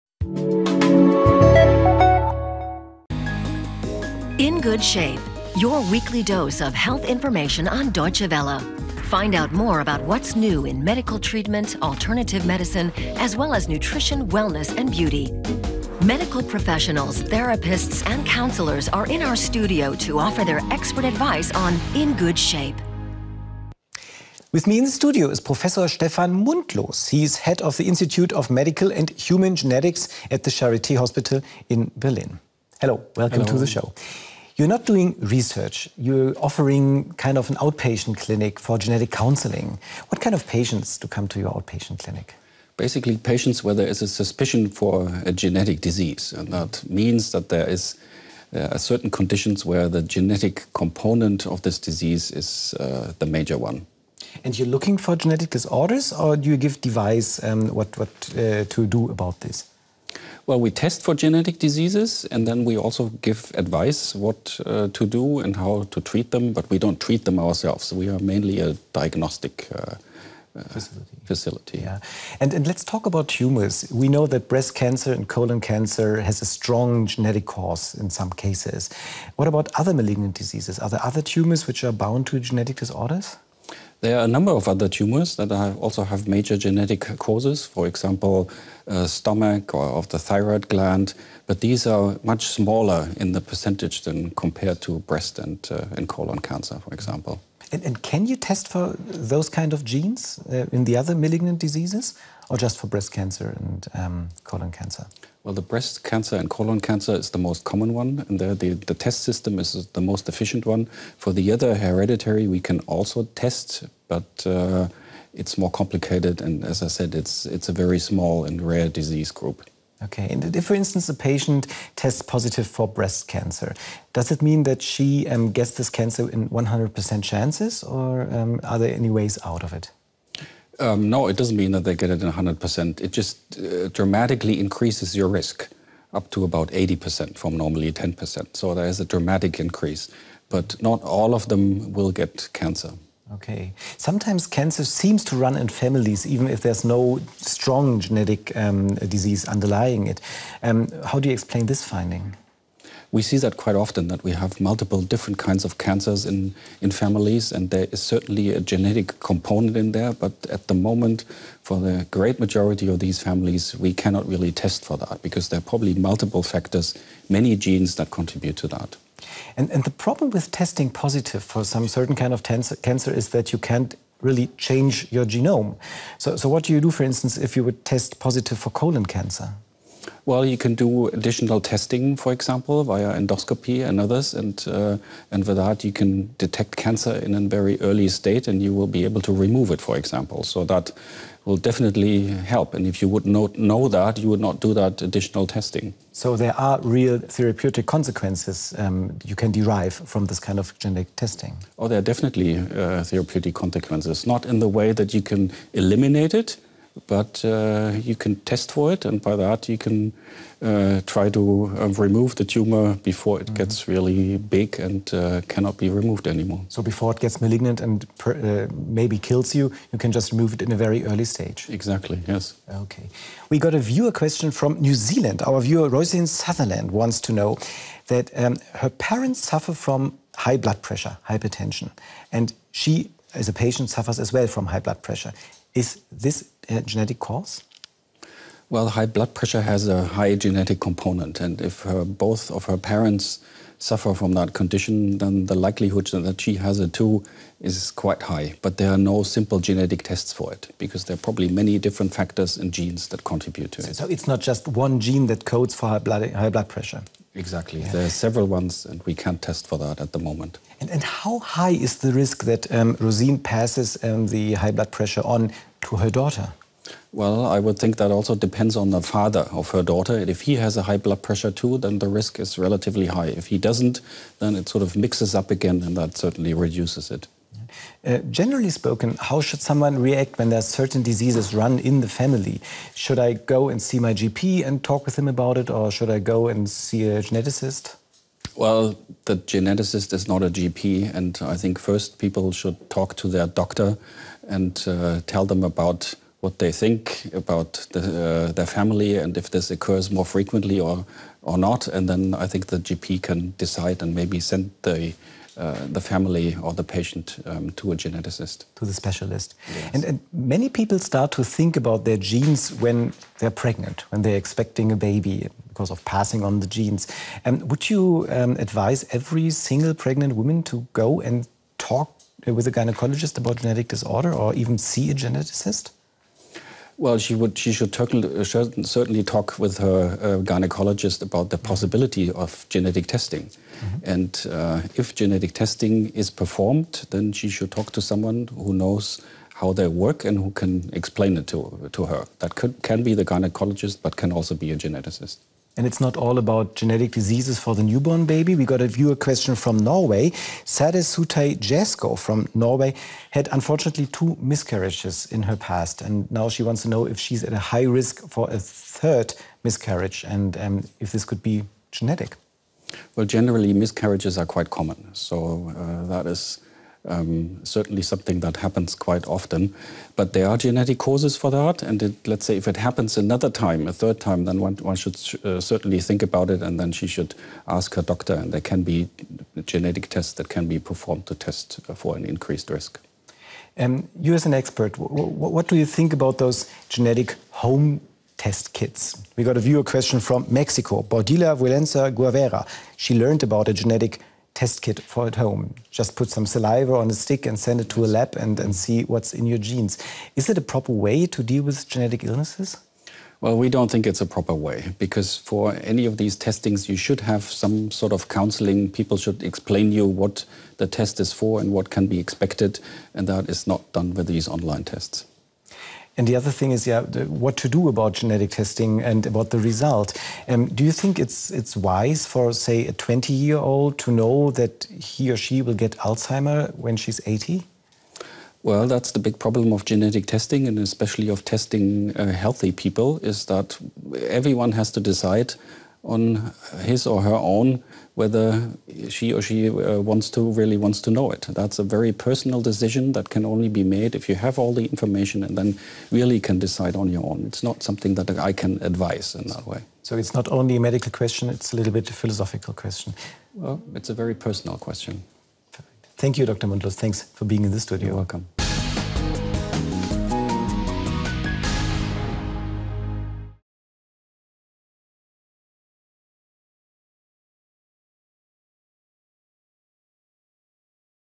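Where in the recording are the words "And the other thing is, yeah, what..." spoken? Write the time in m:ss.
6:56.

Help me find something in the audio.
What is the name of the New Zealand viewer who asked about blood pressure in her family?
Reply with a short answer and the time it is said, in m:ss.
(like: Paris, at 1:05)
Rosalind Sutherland, at 3:45.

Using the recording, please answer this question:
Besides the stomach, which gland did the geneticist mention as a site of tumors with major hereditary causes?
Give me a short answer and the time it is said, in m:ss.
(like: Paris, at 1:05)
thyroid gland, at 1:30.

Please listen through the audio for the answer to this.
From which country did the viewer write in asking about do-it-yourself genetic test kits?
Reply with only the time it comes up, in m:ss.
6:30.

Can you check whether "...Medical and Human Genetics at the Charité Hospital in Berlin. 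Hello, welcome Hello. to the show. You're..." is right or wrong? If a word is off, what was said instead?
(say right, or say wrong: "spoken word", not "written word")
right.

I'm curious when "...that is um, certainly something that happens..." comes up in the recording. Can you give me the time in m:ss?
6:06.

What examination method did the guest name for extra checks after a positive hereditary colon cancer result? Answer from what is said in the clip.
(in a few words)
endoscopy.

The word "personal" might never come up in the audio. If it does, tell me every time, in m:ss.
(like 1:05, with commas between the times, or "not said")
7:22, 7:34.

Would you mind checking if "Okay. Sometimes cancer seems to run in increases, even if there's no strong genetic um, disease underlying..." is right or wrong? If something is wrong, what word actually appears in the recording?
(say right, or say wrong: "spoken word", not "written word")
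wrong: "families", not "increases".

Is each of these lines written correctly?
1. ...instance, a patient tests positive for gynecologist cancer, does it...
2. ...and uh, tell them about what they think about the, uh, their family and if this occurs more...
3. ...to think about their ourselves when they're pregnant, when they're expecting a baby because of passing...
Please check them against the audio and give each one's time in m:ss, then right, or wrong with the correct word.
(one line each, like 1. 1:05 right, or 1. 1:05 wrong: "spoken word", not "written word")
1. 2:00 wrong: "breast", not "gynecologist"
2. 4:54 right
3. 5:11 wrong: "genes", not "ourselves".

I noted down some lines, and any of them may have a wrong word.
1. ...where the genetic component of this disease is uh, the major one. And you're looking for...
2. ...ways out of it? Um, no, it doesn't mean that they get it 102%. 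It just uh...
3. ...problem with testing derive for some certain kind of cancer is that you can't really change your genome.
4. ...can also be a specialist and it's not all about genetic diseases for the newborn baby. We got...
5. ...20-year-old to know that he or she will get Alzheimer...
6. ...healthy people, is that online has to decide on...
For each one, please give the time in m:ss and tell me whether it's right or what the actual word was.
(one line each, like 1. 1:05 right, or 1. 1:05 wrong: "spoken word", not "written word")
1. 0:49 right
2. 2:09 wrong: "100", not "102"
3. 2:49 wrong: "positive", not "derive"
4. 5:44 wrong: "geneticist", not "specialist"
5. 7:02 right
6. 7:12 wrong: "everyone", not "online".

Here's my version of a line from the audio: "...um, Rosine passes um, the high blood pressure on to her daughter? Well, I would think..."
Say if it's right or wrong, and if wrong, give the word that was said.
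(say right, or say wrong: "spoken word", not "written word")
right.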